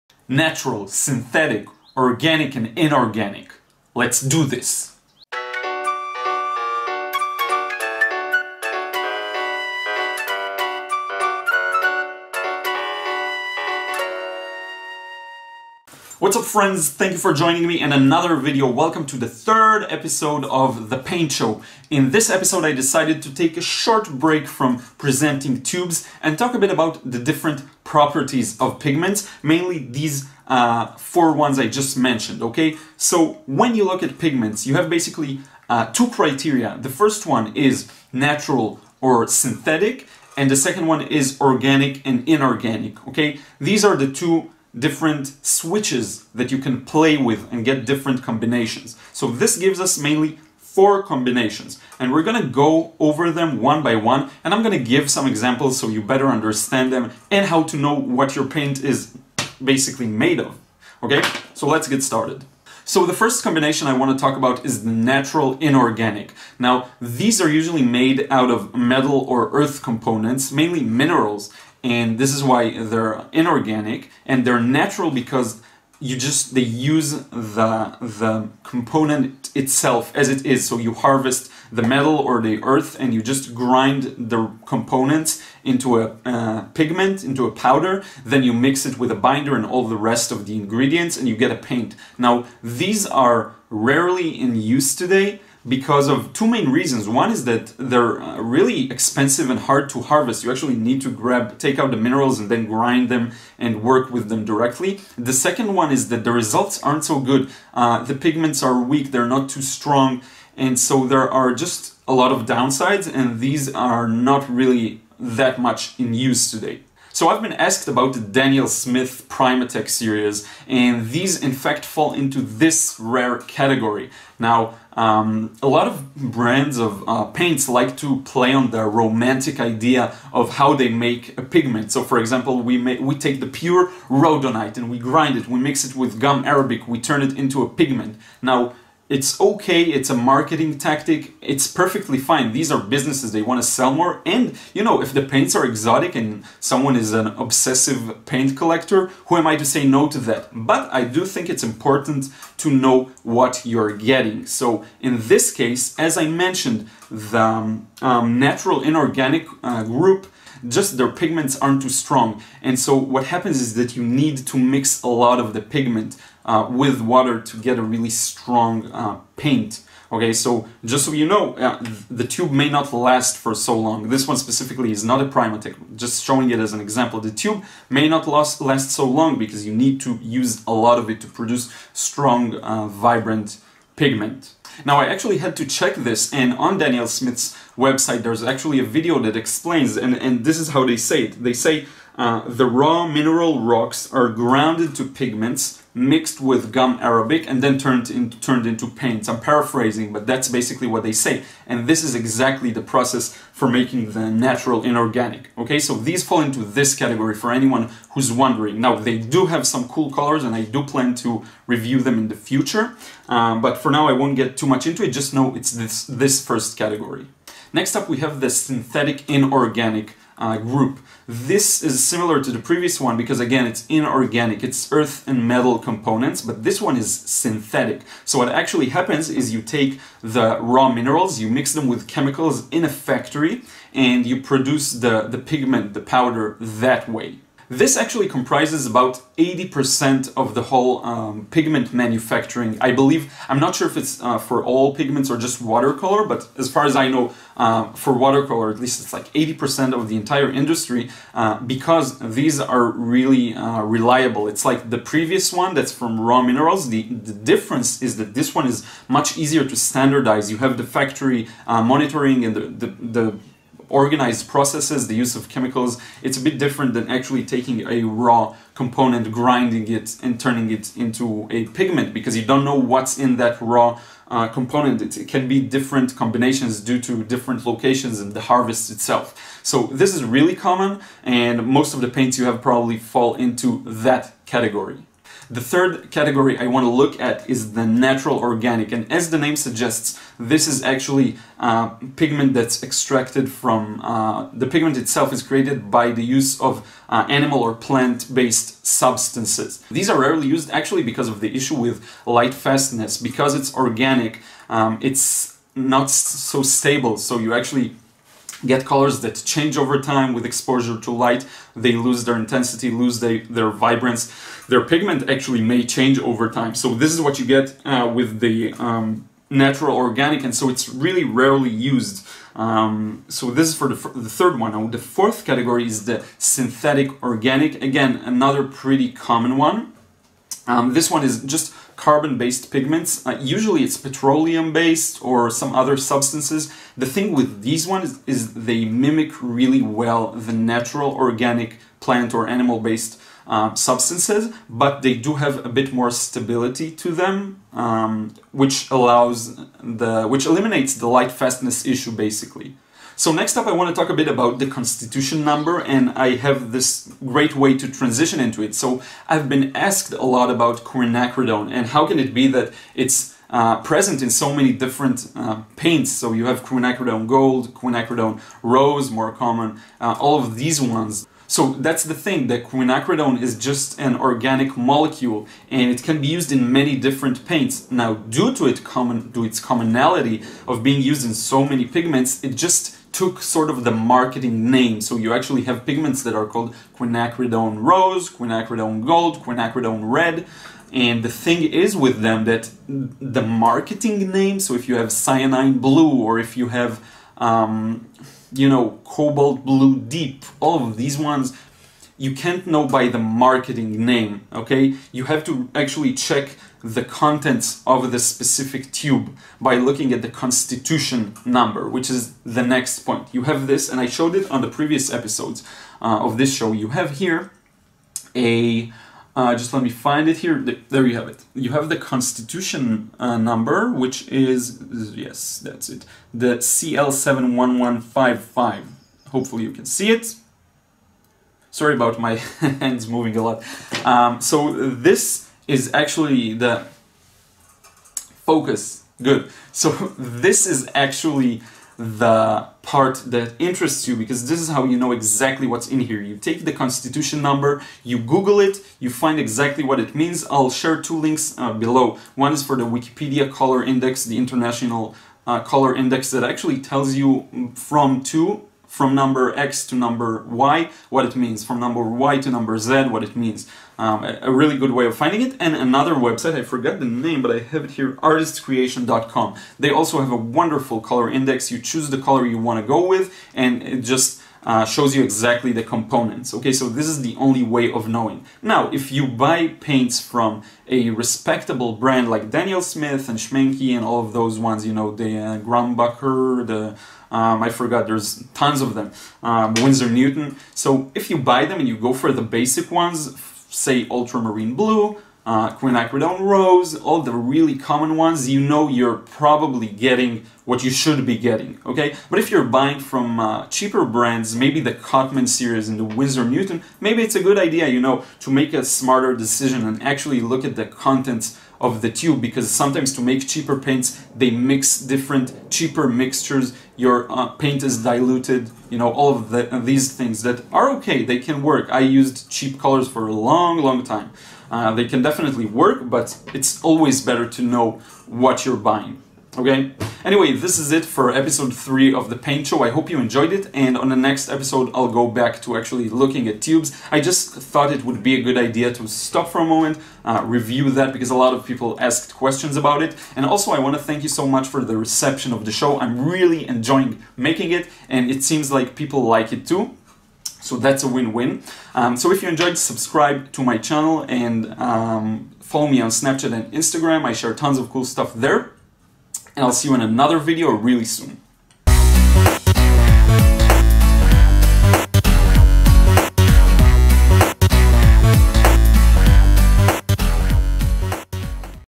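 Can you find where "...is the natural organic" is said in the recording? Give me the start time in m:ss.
4:47.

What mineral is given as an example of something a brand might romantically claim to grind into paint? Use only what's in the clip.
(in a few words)
rhodonite.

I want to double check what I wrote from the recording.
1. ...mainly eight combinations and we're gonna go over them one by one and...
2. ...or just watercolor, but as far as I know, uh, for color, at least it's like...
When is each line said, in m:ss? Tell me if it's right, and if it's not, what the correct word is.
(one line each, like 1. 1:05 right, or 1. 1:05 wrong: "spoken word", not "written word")
1. 0:49 wrong: "four", not "eight"
2. 4:05 wrong: "watercolor", not "color".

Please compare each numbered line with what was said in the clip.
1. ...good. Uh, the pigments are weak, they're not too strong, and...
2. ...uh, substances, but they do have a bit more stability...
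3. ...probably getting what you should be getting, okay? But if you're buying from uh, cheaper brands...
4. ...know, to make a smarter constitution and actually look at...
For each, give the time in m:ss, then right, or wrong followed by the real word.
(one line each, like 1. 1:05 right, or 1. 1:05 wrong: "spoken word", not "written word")
1. 1:47 right
2. 5:43 right
3. 8:19 right
4. 8:27 wrong: "decision", not "constitution".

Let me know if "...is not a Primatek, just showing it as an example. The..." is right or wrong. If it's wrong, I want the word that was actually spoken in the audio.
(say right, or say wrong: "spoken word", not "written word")
right.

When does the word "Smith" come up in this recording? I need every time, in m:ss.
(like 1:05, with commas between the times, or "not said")
1:58, 3:07, 8:02.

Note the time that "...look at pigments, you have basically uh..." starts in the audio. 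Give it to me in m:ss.
0:33.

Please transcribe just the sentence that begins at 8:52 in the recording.
I hope you enjoyed it, and on the next episode, I'll go back to actually looking at tubes.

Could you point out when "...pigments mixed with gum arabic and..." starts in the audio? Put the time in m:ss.
3:15.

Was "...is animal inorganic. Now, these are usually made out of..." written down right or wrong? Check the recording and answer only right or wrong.
wrong.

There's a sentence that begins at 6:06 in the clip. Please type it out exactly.
So you have quinacridone gold, quinacridone rose, more common, uh, all of these ones.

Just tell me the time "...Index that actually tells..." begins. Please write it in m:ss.
7:35.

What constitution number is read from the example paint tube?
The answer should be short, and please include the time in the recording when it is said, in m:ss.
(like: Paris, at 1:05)
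CL71155, at 7:06.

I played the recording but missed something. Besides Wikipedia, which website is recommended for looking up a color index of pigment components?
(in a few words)
artiscreation.com.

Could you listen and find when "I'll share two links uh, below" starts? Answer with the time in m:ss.
7:30.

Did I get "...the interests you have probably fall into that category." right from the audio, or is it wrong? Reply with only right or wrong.
wrong.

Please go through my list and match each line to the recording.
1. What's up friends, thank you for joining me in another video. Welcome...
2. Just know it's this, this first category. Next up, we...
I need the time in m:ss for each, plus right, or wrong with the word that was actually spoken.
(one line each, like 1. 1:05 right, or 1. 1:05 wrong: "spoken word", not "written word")
1. 0:16 right
2. 3:35 right.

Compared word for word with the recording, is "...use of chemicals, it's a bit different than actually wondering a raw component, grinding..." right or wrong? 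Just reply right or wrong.
wrong.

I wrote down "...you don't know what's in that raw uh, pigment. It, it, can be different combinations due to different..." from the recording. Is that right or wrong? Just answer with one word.
wrong.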